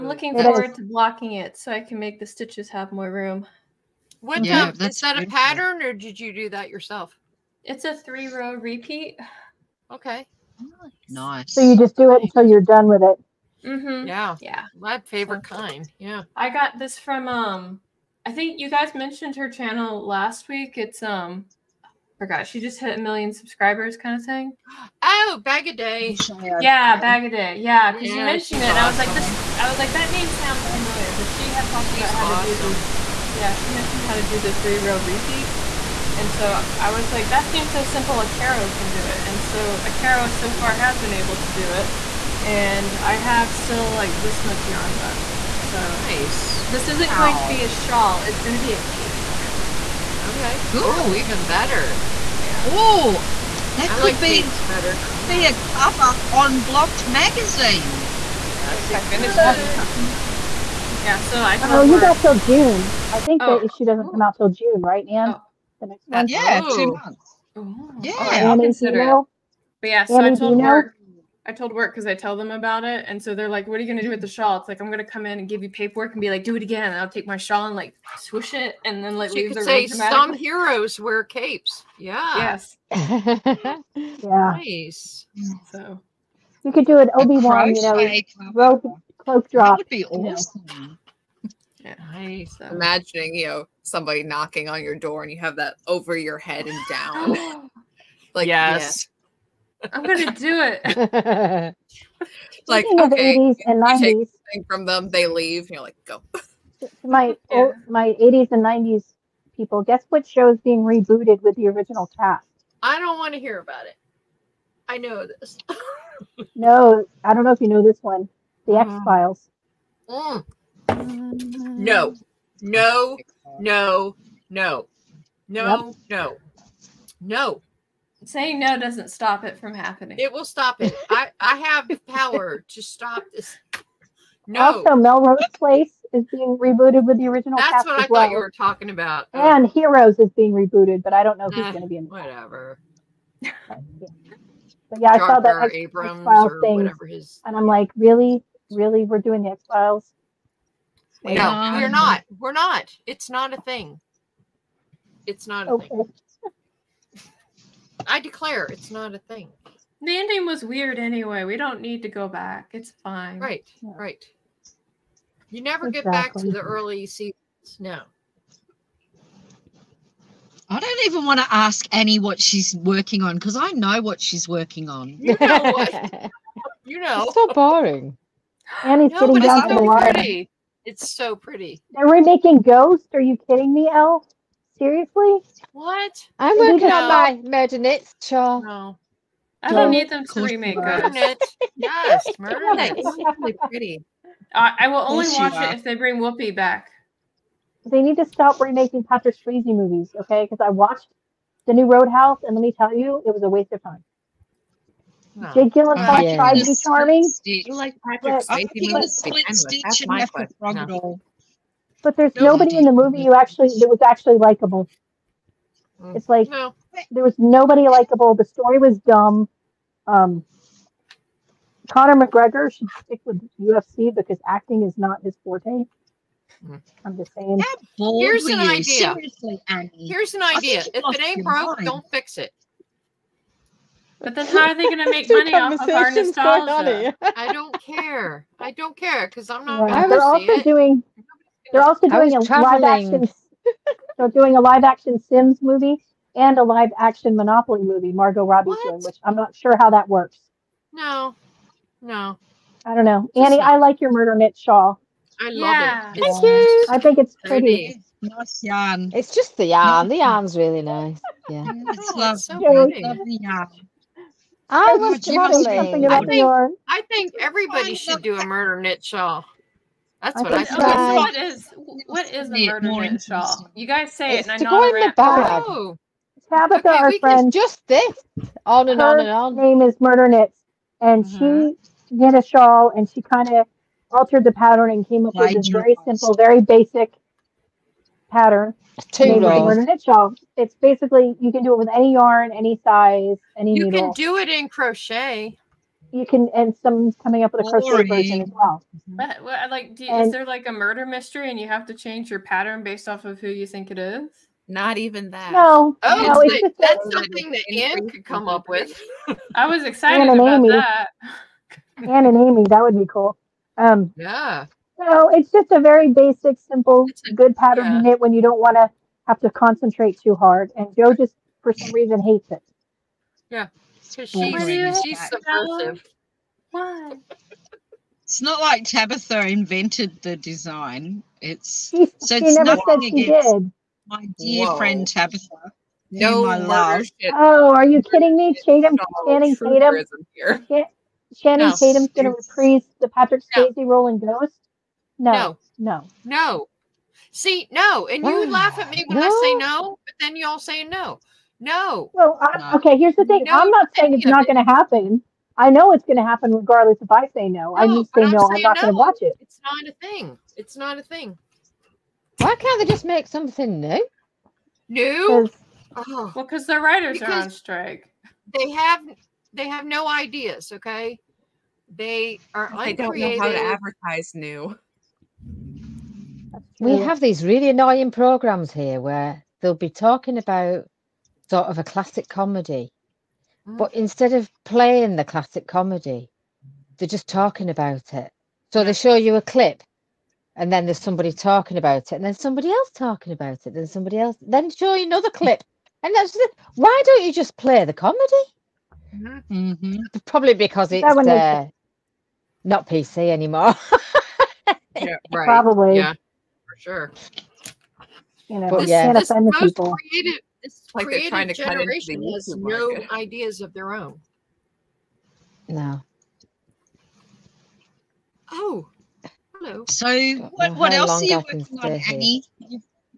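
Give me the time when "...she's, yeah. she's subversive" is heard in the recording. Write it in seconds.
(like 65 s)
324 s.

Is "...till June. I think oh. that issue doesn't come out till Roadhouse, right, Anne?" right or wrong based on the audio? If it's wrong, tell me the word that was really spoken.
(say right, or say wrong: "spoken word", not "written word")
wrong: "June", not "Roadhouse".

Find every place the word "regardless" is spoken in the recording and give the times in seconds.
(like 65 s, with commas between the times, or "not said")
356 s.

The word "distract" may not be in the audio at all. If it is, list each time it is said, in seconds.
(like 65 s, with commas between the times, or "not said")
not said.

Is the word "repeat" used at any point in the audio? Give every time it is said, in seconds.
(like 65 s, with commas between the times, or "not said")
8 s, 35 s.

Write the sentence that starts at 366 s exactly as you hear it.
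Well, because the writers because are on strike.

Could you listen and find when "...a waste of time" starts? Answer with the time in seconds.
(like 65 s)
203 s.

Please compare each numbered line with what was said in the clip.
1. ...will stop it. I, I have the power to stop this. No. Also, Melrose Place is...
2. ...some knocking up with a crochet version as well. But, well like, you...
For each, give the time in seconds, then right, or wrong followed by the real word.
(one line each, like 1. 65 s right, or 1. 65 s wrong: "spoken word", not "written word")
1. 130 s right
2. 296 s wrong: "coming", not "knocking".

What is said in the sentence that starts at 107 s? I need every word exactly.
my 80s and 90s people, guess what show is being rebooted with the original cast?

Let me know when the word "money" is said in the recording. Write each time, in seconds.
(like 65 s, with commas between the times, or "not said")
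235 s.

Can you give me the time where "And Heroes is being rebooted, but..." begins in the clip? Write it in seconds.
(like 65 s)
139 s.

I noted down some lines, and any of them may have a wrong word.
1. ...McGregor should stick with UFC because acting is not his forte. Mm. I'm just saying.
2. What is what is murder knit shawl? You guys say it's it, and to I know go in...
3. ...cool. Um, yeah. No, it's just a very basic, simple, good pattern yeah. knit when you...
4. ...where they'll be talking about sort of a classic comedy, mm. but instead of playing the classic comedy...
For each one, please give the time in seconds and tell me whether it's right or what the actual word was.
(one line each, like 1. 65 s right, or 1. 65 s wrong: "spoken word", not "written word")
1. 222 s right
2. 270 s right
3. 313 s right
4. 379 s right.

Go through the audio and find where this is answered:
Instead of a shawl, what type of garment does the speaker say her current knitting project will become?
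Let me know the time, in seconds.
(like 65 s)
48 s.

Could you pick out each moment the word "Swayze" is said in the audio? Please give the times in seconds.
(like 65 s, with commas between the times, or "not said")
199 s, 208 s, 343 s.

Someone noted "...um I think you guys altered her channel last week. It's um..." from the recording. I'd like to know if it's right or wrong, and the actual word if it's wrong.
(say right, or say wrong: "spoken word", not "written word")
wrong: "mentioned", not "altered".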